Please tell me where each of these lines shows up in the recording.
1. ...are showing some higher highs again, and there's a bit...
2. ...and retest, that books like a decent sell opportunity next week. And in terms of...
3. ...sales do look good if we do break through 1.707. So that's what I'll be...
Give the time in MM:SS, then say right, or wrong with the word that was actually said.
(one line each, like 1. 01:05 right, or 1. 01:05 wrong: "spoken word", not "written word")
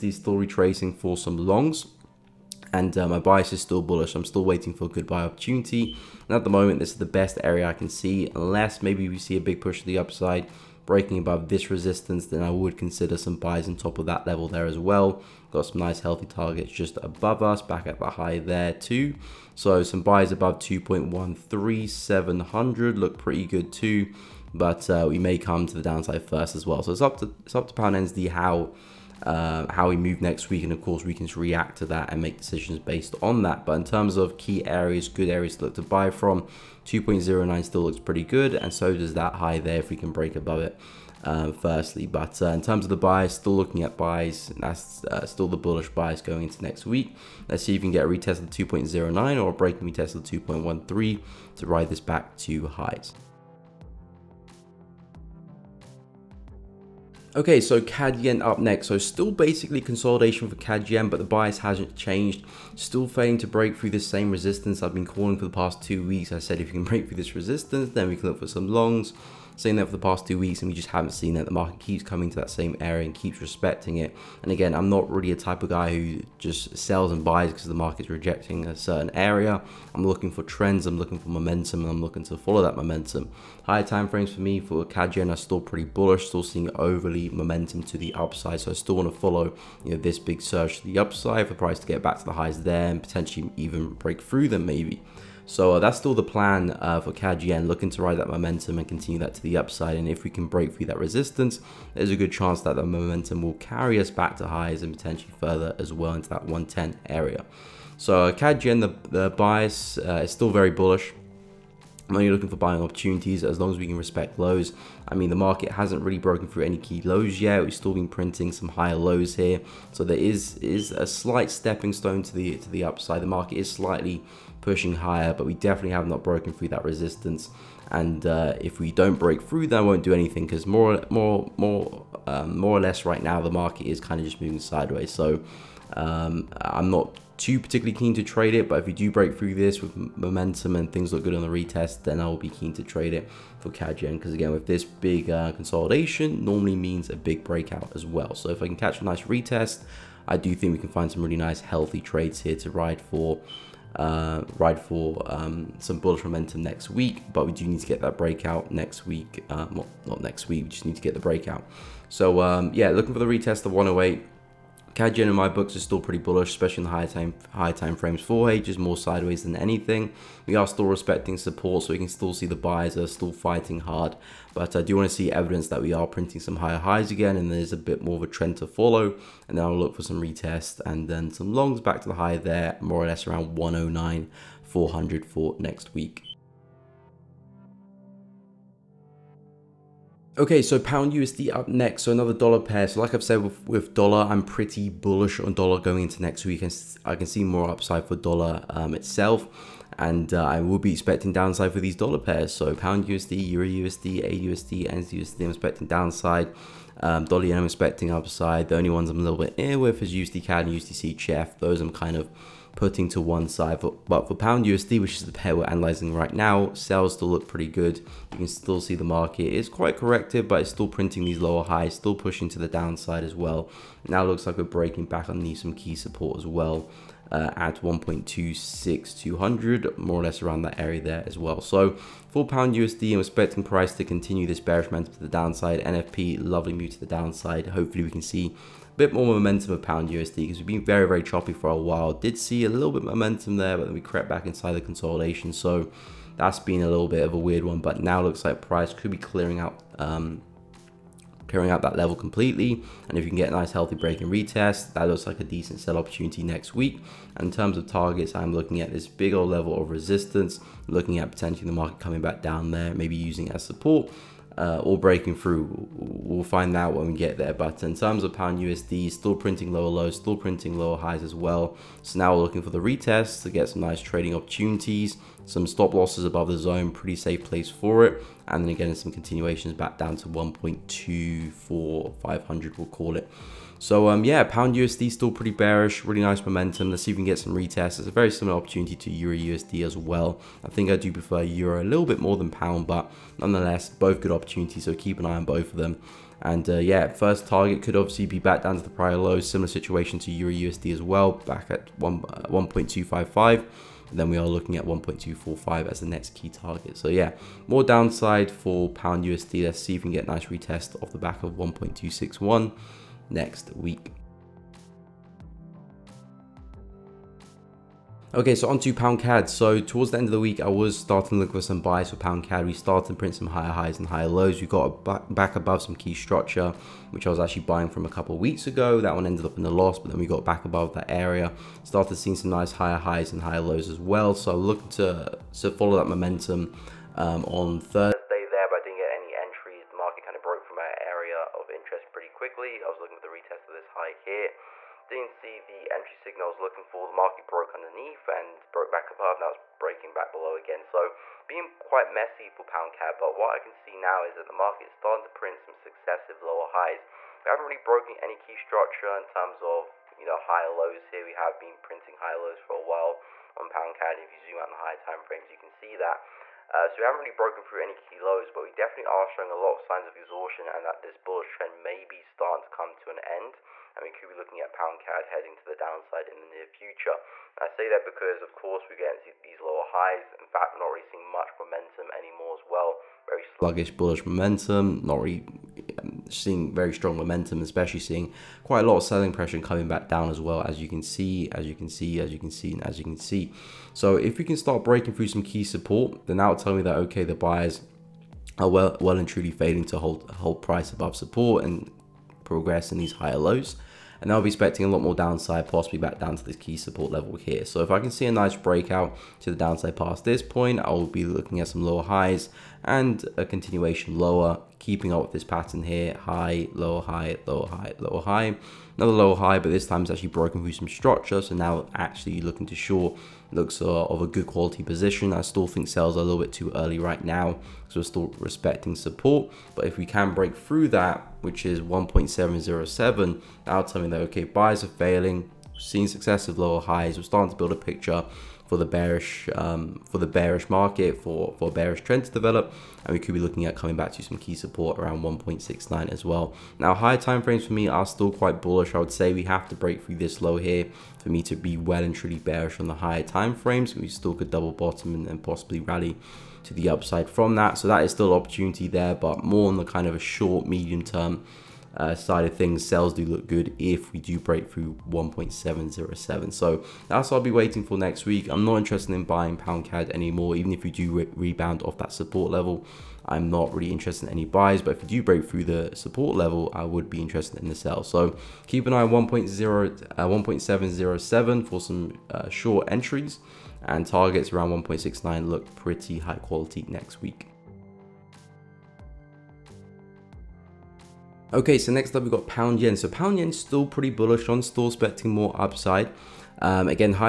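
1. 02:55 wrong: "printing", not "showing"
2. 04:14 wrong: "looks", not "books"
3. 07:42 right.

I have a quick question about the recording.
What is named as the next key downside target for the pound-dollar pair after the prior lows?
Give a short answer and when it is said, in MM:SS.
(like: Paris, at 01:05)
1.245, at 05:04.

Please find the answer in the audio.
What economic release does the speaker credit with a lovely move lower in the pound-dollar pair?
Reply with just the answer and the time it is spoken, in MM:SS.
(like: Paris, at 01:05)
NFP, at 03:55.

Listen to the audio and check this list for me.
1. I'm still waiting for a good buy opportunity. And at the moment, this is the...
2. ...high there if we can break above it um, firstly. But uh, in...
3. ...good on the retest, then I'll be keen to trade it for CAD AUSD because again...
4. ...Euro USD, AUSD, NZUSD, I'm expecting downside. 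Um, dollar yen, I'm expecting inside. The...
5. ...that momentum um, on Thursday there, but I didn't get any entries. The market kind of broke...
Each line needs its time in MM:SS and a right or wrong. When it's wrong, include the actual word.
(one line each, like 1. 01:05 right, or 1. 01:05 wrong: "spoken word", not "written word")
1. 00:04 right
2. 00:39 right
3. 02:21 wrong: "Yen", not "AUSD"
4. 03:23 wrong: "upside", not "inside"
5. 05:35 right.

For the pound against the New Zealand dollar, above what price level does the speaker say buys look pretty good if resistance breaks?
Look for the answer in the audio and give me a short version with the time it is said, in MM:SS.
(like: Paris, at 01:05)
2.13700, at 00:20.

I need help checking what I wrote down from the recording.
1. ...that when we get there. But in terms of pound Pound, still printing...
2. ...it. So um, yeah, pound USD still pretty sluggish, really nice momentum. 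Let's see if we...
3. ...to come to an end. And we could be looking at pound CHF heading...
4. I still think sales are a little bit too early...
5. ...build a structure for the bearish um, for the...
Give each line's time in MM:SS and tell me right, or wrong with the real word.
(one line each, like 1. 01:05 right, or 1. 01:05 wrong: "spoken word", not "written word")
1. 04:26 wrong: "USD", not "Pound"
2. 04:43 wrong: "bearish", not "sluggish"
3. 06:12 wrong: "CAD", not "CHF"
4. 07:05 right
5. 07:17 wrong: "picture", not "structure".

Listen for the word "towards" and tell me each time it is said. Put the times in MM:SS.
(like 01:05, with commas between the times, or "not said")
05:19.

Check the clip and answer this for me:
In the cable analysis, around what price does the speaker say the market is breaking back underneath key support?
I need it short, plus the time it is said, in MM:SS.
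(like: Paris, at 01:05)
1.26200, at 03:47.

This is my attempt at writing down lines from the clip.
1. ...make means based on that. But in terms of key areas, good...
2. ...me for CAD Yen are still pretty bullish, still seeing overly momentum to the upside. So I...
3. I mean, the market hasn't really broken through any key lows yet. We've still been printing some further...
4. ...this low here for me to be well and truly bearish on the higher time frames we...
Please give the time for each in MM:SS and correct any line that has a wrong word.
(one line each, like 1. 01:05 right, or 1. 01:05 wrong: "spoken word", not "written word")
1. 00:32 wrong: "decisions", not "means"
2. 01:24 right
3. 01:55 wrong: "higher", not "further"
4. 07:30 right.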